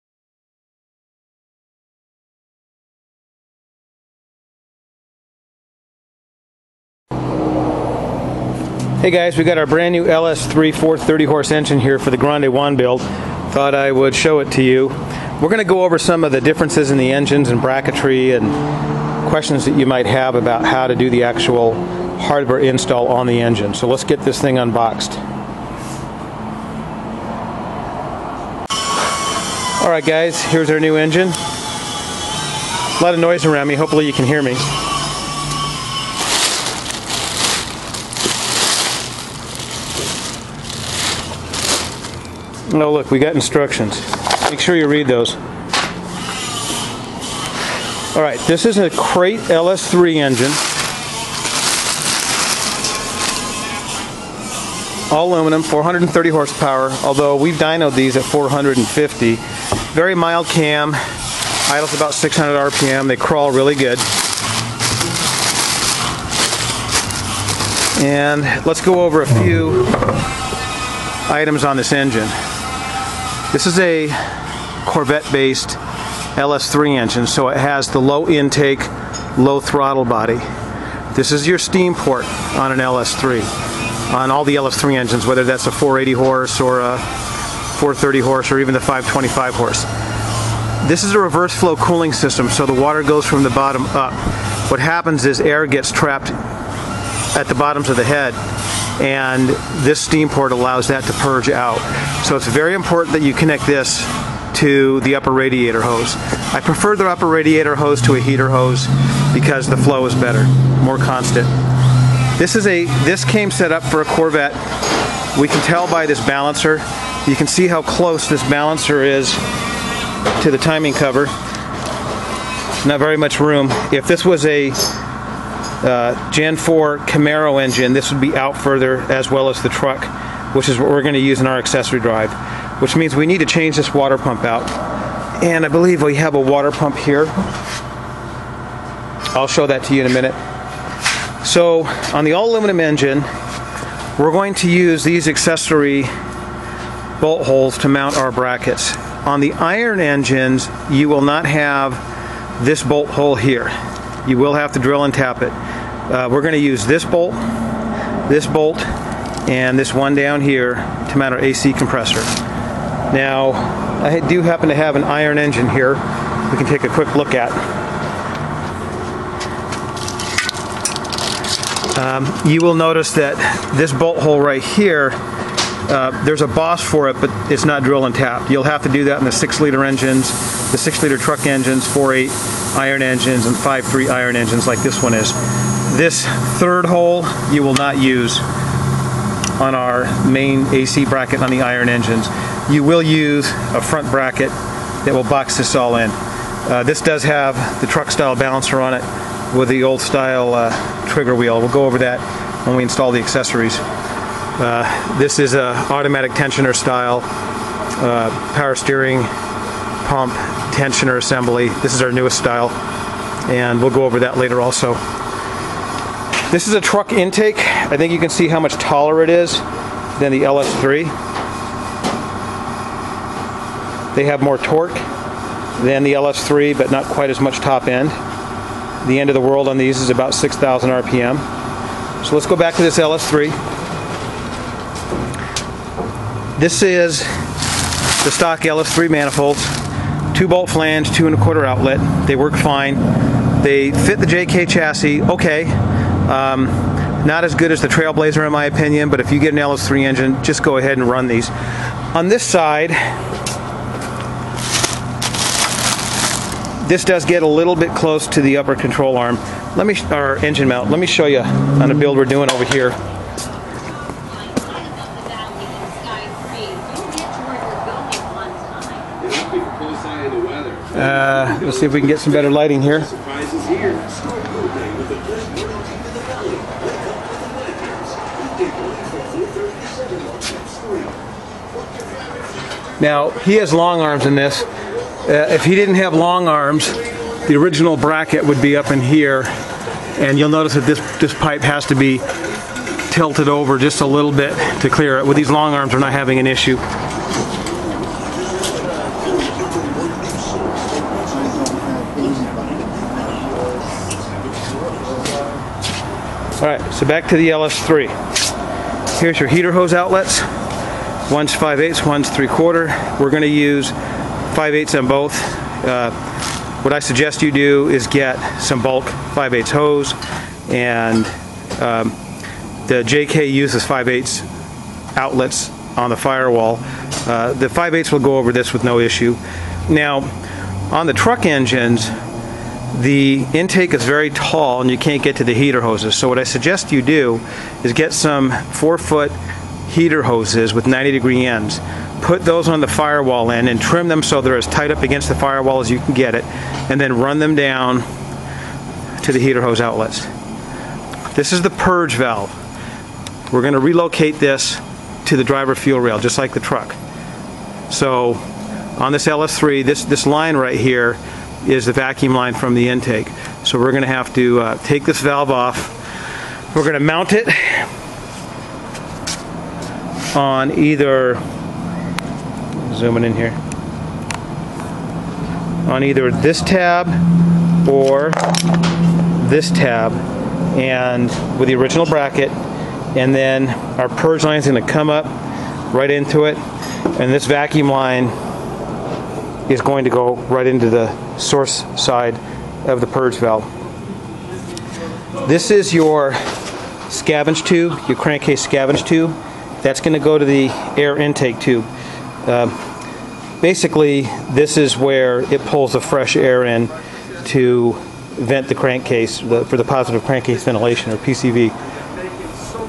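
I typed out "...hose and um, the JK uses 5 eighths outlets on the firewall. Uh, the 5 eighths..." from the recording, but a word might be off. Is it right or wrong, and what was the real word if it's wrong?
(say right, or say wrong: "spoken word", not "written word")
right.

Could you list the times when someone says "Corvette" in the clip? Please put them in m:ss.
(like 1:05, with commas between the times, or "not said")
1:14, 1:54.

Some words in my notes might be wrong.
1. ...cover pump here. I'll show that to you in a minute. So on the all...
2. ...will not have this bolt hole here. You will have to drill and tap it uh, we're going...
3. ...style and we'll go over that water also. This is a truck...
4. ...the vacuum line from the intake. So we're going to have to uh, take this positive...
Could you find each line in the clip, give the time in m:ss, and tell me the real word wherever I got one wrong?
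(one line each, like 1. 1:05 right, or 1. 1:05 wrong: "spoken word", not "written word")
1. 2:16 wrong: "water", not "cover"
2. 2:31 right
3. 3:32 wrong: "later", not "water"
4. 6:01 wrong: "valve", not "positive".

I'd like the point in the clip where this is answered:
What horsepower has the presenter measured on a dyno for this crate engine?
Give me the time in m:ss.
0:58.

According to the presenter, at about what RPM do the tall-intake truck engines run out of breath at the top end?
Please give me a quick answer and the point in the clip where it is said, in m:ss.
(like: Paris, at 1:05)
6,000 RPM, at 3:50.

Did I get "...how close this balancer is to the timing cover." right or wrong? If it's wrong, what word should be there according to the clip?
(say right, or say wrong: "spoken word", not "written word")
right.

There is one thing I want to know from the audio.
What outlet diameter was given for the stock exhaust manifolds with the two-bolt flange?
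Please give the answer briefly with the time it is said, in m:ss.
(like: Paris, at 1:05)
2 1/4 inch, at 4:01.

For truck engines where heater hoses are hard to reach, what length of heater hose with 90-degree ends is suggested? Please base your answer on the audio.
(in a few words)
4 feet.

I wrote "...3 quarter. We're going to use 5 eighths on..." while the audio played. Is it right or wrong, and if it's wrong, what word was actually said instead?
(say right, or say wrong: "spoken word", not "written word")
right.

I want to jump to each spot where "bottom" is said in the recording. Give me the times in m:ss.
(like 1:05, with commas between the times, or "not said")
1:33, 1:37.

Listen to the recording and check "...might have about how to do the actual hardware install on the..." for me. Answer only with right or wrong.
right.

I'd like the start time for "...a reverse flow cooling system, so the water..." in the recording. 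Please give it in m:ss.
1:31.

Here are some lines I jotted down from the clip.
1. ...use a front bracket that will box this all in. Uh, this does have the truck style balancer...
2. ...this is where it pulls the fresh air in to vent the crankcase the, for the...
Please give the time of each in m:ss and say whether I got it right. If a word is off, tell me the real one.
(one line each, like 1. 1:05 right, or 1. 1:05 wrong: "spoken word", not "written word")
1. 3:13 right
2. 6:44 right.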